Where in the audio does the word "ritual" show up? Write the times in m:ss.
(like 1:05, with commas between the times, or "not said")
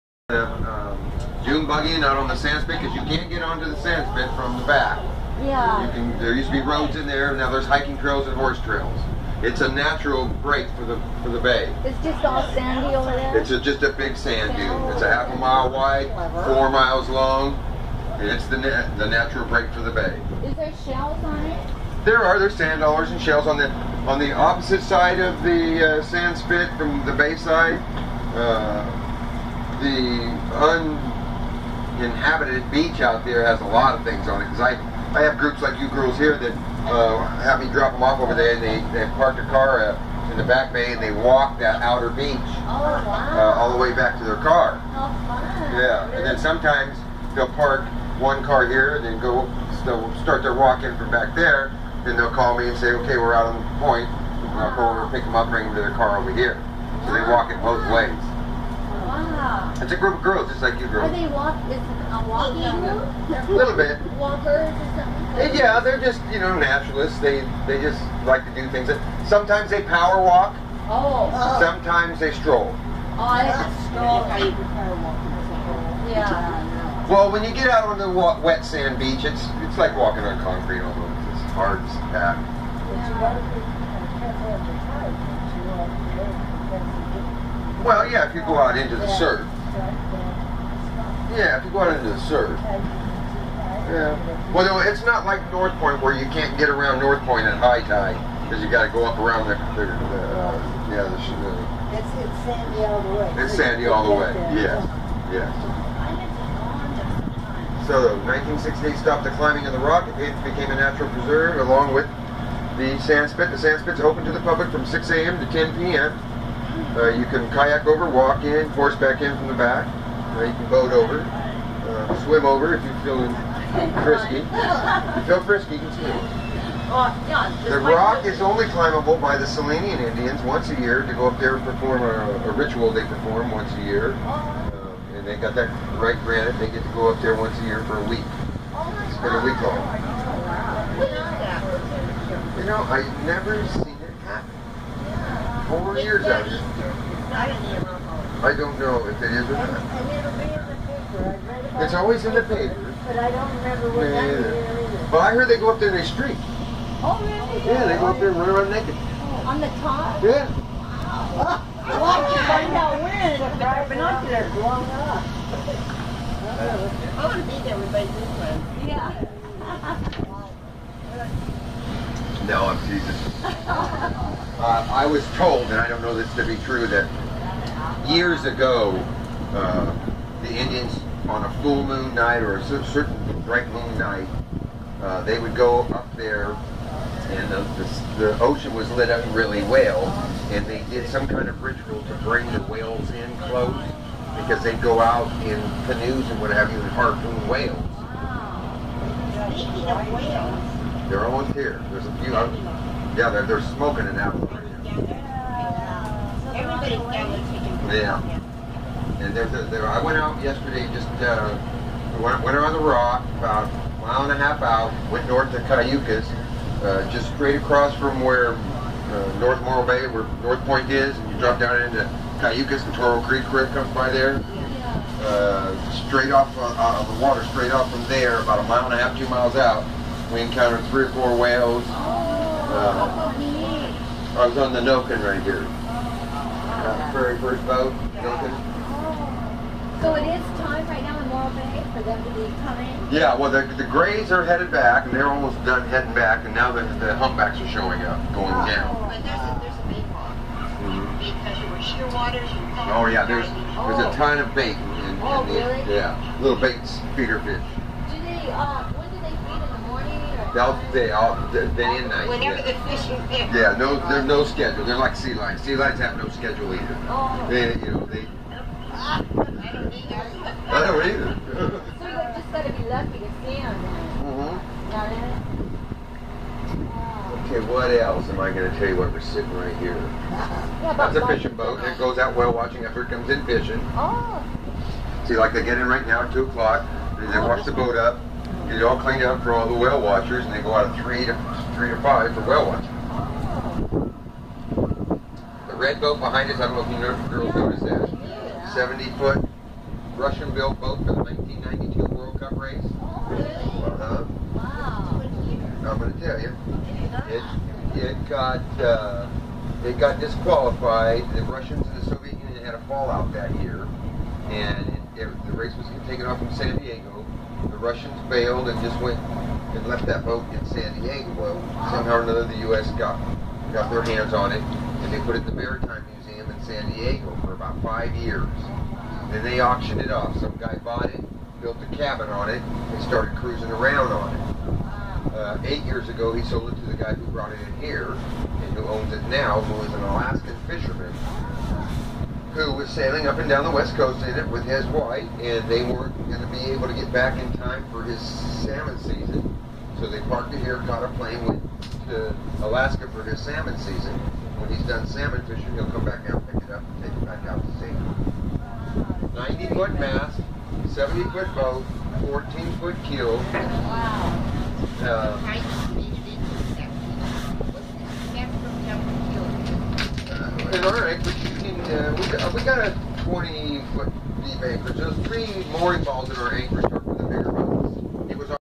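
2:12, 3:11.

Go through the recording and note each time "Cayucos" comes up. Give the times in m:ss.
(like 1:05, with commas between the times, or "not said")
3:35, 3:42.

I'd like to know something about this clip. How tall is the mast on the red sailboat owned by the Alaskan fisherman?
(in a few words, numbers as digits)
90 feet.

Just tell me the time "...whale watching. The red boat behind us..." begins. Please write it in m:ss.
4:52.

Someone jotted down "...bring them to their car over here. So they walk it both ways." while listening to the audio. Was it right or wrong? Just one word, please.
right.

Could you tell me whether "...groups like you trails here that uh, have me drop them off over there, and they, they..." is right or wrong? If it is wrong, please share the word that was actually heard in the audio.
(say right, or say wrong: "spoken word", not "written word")
wrong: "girls", not "trails".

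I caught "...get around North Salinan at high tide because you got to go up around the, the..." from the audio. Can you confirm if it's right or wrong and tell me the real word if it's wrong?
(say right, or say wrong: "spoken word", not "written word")
wrong: "Point", not "Salinan".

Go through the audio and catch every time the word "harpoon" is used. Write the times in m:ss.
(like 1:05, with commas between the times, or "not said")
3:16.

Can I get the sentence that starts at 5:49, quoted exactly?
So they parked it here, caught a plane, went to Alaska for his salmon season.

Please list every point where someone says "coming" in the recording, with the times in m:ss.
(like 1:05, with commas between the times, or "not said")
4:02.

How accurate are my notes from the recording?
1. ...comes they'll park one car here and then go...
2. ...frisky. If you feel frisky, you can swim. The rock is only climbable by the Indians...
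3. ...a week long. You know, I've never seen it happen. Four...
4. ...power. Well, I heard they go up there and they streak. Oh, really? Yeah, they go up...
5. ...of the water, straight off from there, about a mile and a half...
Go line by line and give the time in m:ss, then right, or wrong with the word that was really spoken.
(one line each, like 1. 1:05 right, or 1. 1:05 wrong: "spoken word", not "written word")
1. 0:46 wrong: "sometimes", not "comes"
2. 2:04 wrong: "Salinan", not "Indians"
3. 2:19 right
4. 2:34 wrong: "either", not "power"
5. 3:47 right.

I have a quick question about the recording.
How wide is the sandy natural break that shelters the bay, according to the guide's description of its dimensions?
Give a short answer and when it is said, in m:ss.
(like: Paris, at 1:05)
half a mile, at 0:15.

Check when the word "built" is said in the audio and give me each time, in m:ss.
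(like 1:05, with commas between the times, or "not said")
5:00, 5:31.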